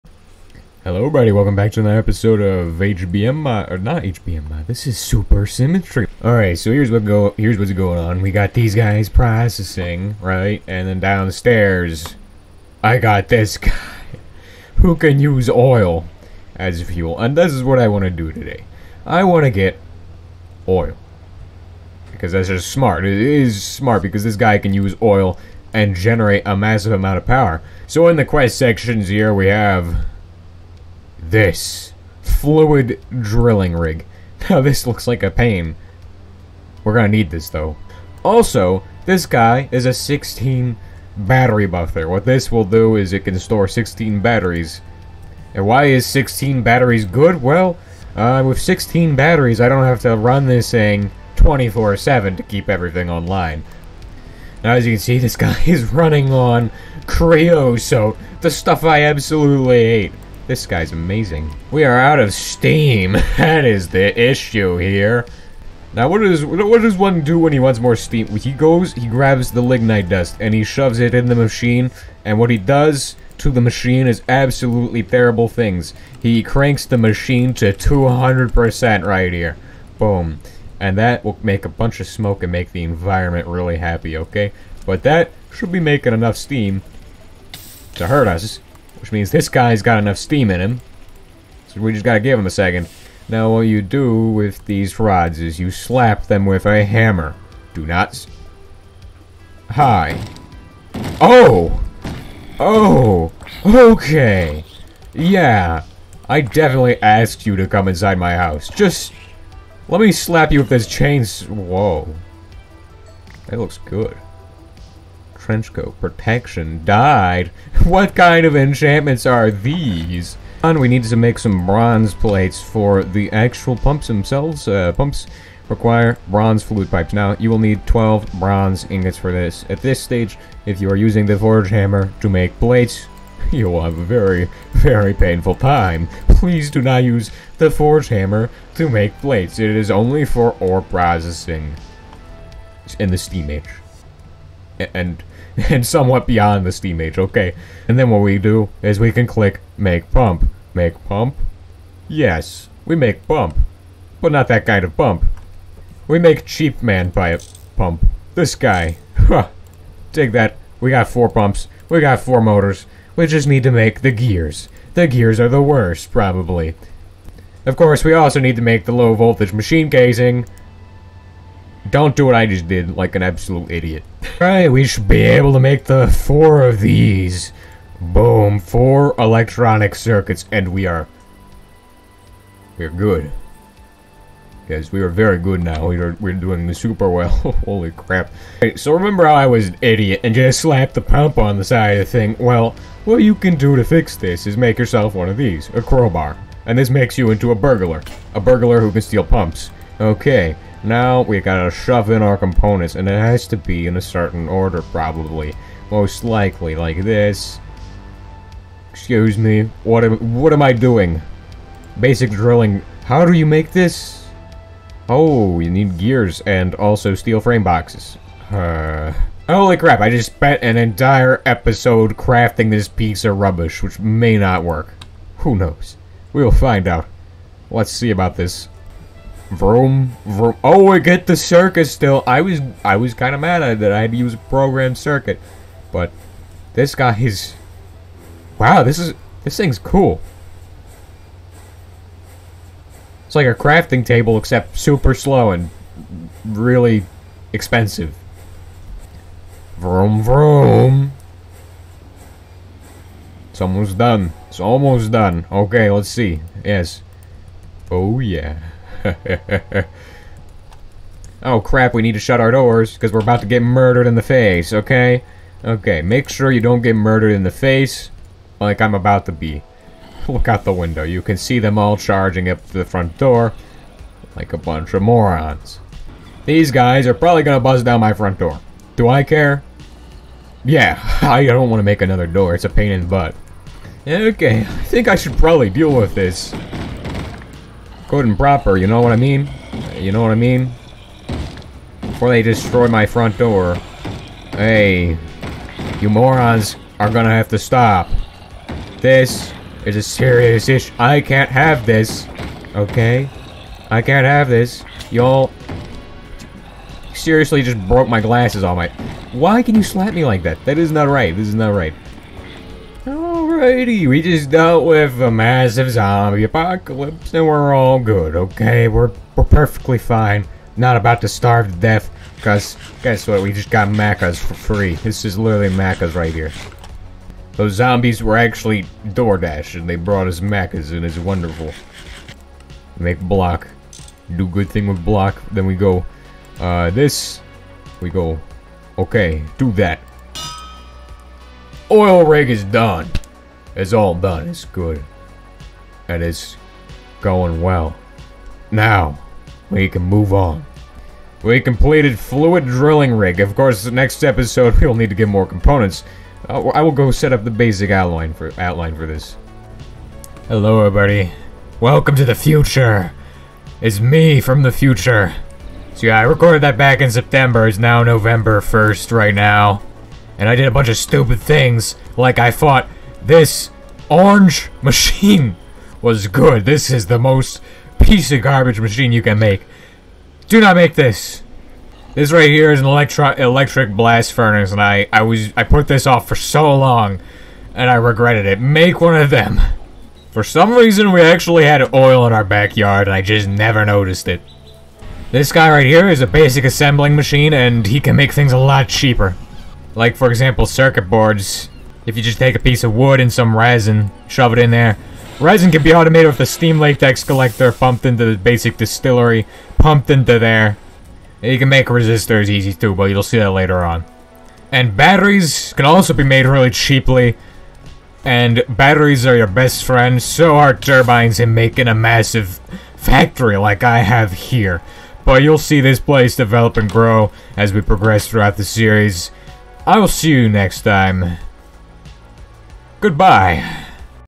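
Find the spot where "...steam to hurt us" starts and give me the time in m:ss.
1:26.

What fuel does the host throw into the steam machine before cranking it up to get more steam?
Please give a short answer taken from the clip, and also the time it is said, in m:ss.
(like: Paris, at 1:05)
lignite dust, at 1:09.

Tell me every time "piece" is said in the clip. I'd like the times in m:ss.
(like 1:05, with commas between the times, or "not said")
3:42, 6:18, 6:42.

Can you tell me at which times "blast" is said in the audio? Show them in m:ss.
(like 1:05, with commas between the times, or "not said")
6:23.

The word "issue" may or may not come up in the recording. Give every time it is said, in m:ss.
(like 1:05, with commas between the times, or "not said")
1:04, 5:00.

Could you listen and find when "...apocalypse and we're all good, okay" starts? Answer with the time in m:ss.
5:16.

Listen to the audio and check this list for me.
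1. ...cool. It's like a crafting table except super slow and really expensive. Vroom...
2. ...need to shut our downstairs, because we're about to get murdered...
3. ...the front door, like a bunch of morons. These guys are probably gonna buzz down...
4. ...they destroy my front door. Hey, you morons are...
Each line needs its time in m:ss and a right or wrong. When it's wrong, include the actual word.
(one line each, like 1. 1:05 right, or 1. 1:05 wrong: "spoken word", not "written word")
1. 3:59 right
2. 4:22 wrong: "doors", not "downstairs"
3. 4:32 right
4. 4:52 right.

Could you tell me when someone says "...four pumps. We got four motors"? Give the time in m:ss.
2:41.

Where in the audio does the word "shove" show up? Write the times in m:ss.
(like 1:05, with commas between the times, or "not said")
1:10, 3:21, 6:44.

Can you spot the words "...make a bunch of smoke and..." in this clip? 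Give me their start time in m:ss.
1:21.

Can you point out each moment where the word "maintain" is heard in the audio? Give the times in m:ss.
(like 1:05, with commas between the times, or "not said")
not said.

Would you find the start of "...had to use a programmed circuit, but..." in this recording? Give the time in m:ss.
3:53.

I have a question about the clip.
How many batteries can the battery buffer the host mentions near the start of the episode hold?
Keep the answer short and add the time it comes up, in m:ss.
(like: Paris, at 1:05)
16, at 0:43.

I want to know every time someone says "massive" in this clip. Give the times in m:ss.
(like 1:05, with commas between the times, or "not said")
0:26, 5:15, 7:01.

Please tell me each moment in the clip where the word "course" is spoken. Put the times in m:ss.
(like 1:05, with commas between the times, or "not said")
2:47, 5:53.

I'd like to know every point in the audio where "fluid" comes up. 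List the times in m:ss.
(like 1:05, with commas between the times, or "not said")
0:32, 2:06, 5:52.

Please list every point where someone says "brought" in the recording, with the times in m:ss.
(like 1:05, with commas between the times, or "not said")
5:29.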